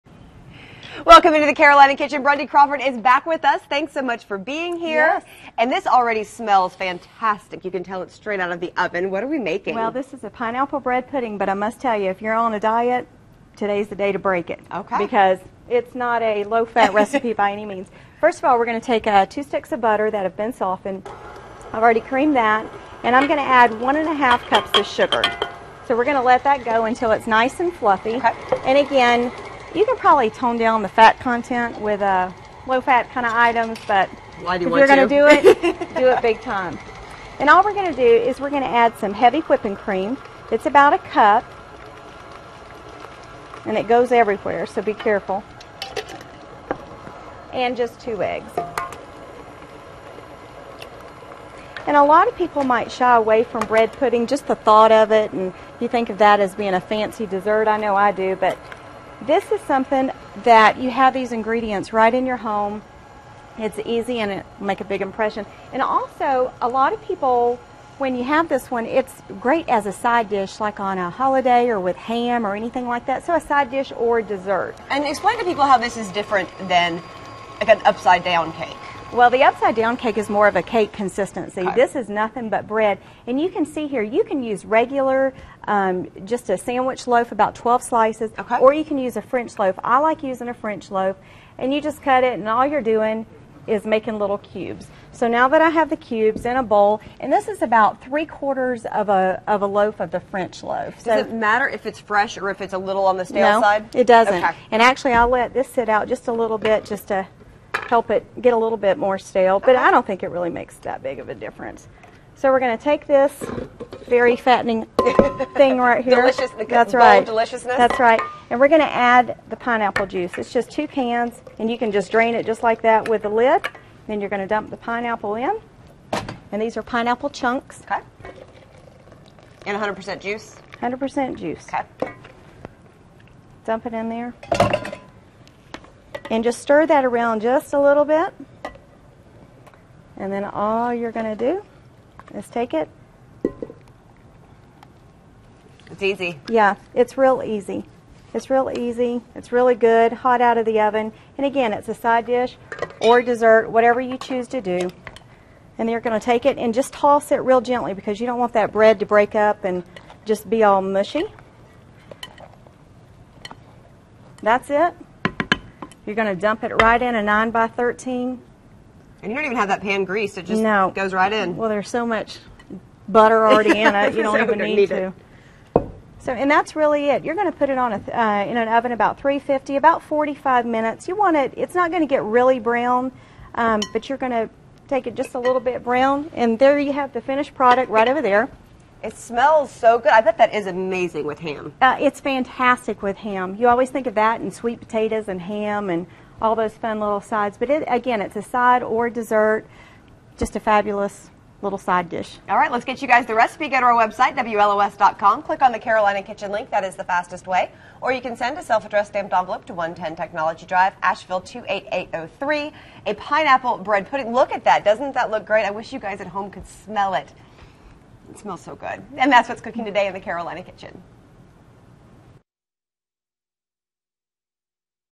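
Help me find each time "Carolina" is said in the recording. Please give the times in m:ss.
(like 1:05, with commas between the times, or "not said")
0:01, 3:25, 3:40.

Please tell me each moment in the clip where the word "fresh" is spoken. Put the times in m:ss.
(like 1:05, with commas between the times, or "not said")
1:41.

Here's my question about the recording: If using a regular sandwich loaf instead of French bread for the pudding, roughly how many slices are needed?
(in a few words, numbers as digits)
12 slices.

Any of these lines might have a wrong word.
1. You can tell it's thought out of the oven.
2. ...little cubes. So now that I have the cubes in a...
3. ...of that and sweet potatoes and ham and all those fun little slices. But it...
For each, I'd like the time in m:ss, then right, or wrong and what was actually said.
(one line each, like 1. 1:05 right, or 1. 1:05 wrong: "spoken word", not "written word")
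1. 0:07 wrong: "straight", not "thought"
2. 1:34 right
3. 3:14 wrong: "sides", not "slices".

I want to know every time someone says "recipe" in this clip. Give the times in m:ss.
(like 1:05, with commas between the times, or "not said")
0:16, 3:23.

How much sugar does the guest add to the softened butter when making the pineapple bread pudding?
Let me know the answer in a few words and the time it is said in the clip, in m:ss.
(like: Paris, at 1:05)
1.5 cups, at 0:23.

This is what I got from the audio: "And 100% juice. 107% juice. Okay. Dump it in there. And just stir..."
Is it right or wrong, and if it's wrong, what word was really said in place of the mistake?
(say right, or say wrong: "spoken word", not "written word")
wrong: "100", not "107".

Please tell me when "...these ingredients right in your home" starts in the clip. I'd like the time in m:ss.
1:01.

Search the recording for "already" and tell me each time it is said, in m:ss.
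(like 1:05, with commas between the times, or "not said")
0:05, 0:21, 2:53.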